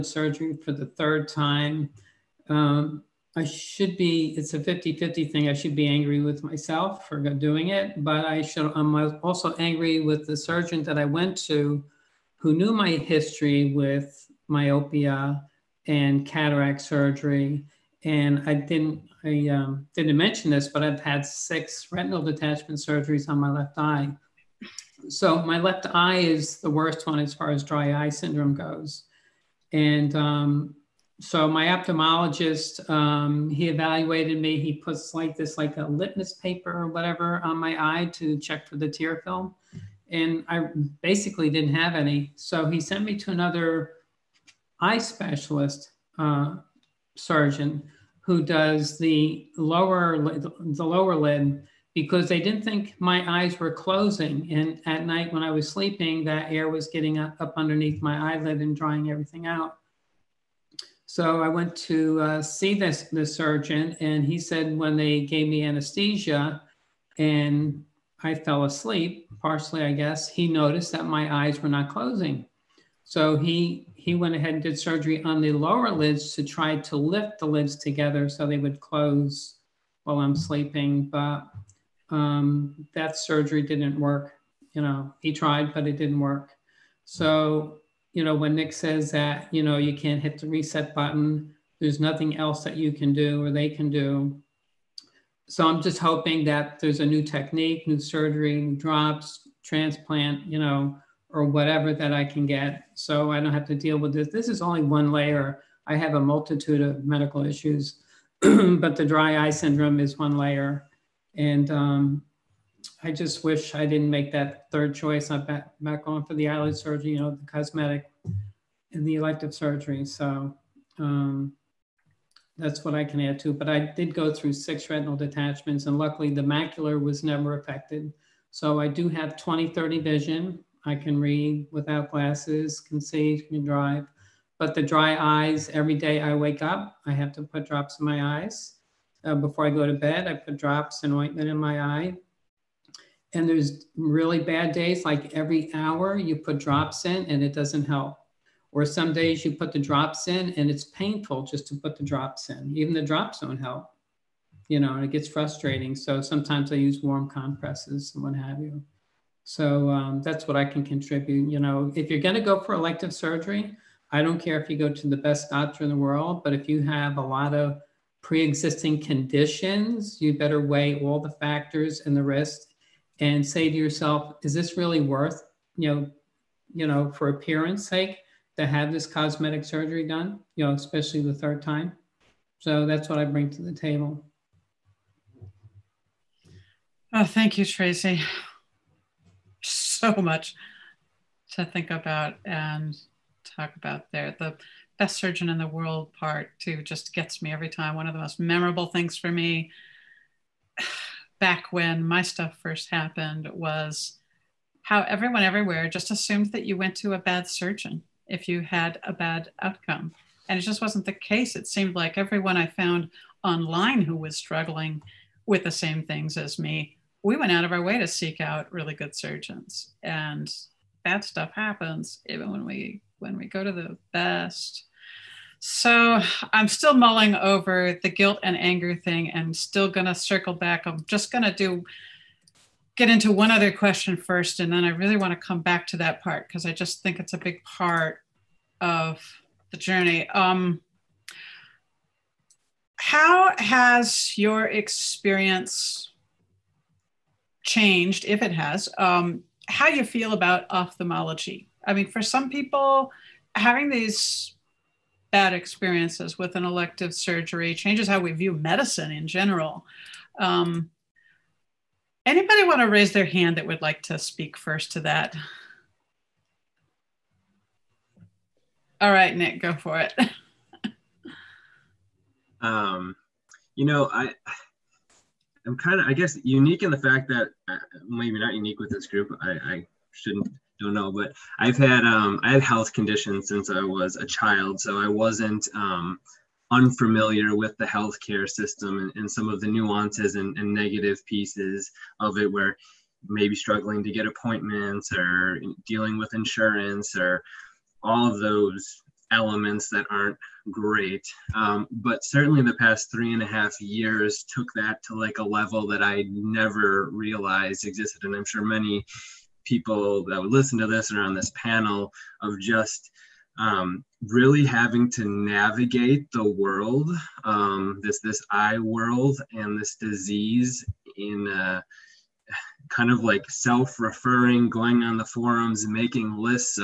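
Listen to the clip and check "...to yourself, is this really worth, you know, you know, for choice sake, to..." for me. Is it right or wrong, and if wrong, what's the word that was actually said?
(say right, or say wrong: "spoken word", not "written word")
wrong: "appearance", not "choice".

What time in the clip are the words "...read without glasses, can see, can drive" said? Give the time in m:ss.
2:11.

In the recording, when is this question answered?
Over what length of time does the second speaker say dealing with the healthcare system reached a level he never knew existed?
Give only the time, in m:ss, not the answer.
5:03.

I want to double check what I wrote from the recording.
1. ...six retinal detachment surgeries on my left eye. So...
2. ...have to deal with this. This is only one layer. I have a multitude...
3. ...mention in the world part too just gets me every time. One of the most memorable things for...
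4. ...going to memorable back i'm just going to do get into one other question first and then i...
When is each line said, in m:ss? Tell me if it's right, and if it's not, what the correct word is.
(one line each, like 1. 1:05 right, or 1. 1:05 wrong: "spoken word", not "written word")
1. 0:21 right
2. 1:43 right
3. 3:15 wrong: "surgeon", not "mention"
4. 3:49 wrong: "circle", not "memorable".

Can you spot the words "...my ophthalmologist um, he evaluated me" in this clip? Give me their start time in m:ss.
0:31.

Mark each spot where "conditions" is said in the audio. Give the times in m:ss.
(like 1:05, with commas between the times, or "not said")
2:49, 4:42.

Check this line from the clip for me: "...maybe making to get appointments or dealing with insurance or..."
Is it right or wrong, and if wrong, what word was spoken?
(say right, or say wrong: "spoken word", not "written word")
wrong: "struggling", not "making".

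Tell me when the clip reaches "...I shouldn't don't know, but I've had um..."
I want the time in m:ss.
4:39.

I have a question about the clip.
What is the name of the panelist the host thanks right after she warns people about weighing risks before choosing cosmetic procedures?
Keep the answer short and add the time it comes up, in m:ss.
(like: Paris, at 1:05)
Tracy, at 3:07.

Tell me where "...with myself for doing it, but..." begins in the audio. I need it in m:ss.
0:06.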